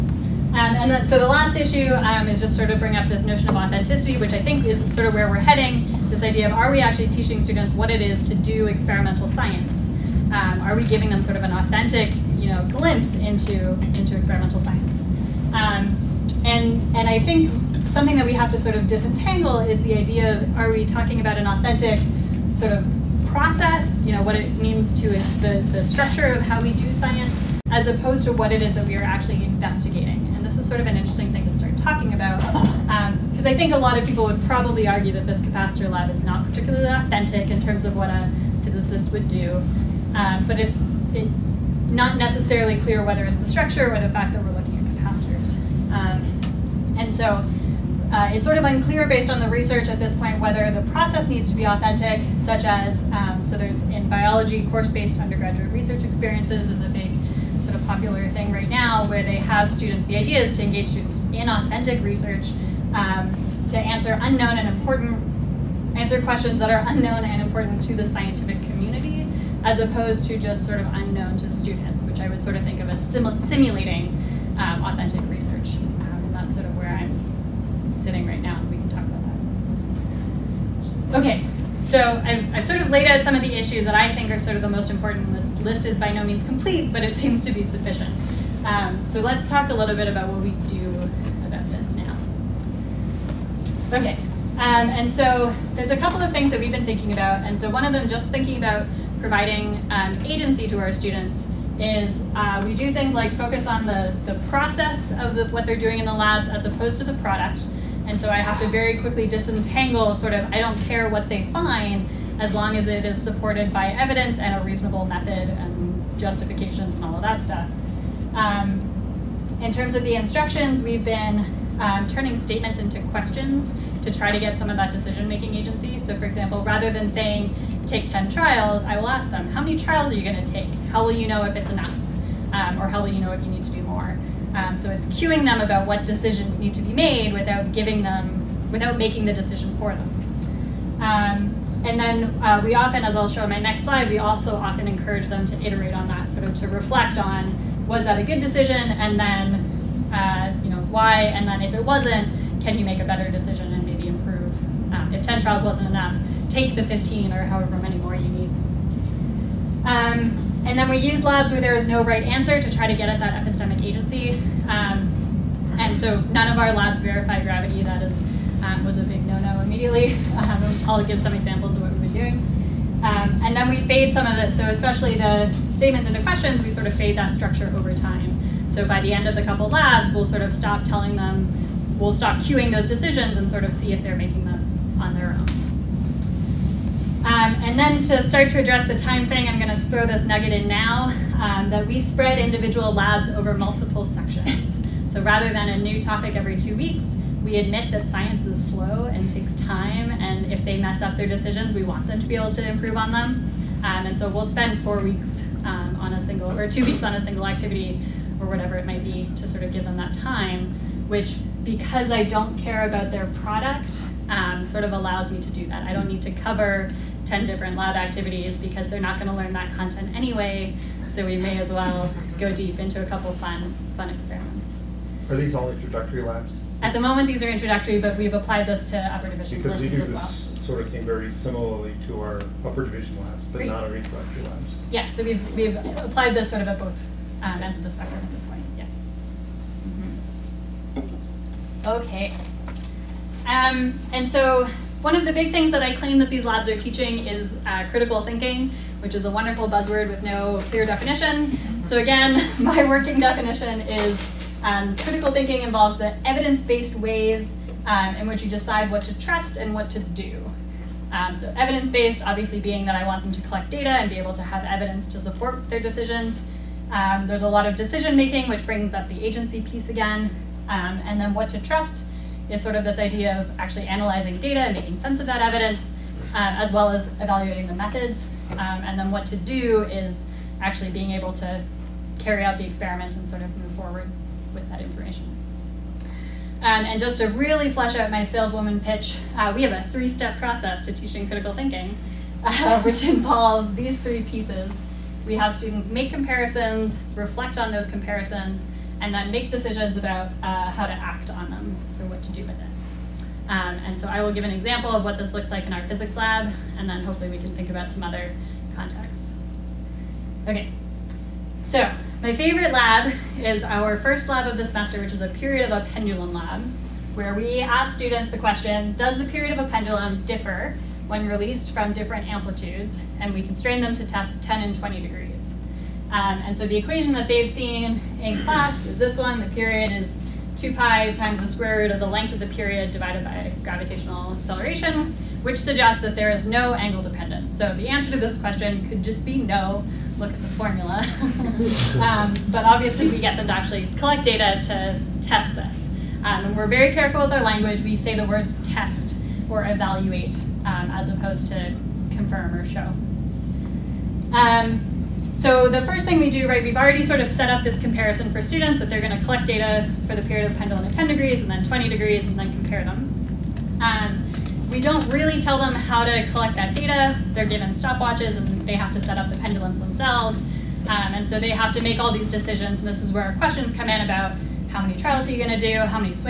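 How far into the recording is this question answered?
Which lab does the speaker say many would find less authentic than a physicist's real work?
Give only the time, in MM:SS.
00:35.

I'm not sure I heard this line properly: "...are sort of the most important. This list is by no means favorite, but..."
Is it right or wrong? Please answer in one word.
wrong.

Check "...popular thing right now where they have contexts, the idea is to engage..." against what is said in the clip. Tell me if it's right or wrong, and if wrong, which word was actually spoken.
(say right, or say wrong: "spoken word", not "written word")
wrong: "students", not "contexts".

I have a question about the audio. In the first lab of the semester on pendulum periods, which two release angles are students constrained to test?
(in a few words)
10 and 20 degrees.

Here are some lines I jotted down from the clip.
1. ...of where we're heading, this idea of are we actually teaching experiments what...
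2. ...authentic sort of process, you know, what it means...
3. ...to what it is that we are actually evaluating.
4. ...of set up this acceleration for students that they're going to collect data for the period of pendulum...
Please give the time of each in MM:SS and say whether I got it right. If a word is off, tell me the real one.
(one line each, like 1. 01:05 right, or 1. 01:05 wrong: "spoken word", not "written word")
1. 00:05 wrong: "students", not "experiments"
2. 00:21 right
3. 00:28 wrong: "investigating", not "evaluating"
4. 05:57 wrong: "comparison", not "acceleration".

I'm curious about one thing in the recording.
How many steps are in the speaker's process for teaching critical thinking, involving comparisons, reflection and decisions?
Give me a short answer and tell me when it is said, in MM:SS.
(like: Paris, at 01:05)
3, at 04:49.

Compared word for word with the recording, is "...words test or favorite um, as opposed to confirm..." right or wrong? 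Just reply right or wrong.
wrong.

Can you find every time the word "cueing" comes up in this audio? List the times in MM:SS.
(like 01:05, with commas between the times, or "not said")
02:15, 03:02.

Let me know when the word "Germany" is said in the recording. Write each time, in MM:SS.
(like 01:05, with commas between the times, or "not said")
not said.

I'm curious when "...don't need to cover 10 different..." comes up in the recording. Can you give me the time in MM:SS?
03:35.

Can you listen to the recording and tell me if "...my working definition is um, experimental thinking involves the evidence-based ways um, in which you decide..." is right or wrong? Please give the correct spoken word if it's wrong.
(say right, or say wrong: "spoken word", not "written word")
wrong: "critical", not "experimental".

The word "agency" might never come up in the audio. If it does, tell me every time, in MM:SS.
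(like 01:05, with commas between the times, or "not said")
01:40, 02:05, 02:43, 04:29.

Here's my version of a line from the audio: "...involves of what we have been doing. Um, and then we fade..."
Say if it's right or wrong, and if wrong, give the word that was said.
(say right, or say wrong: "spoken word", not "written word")
wrong: "examples", not "involves".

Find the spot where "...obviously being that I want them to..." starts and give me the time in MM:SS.
04:22.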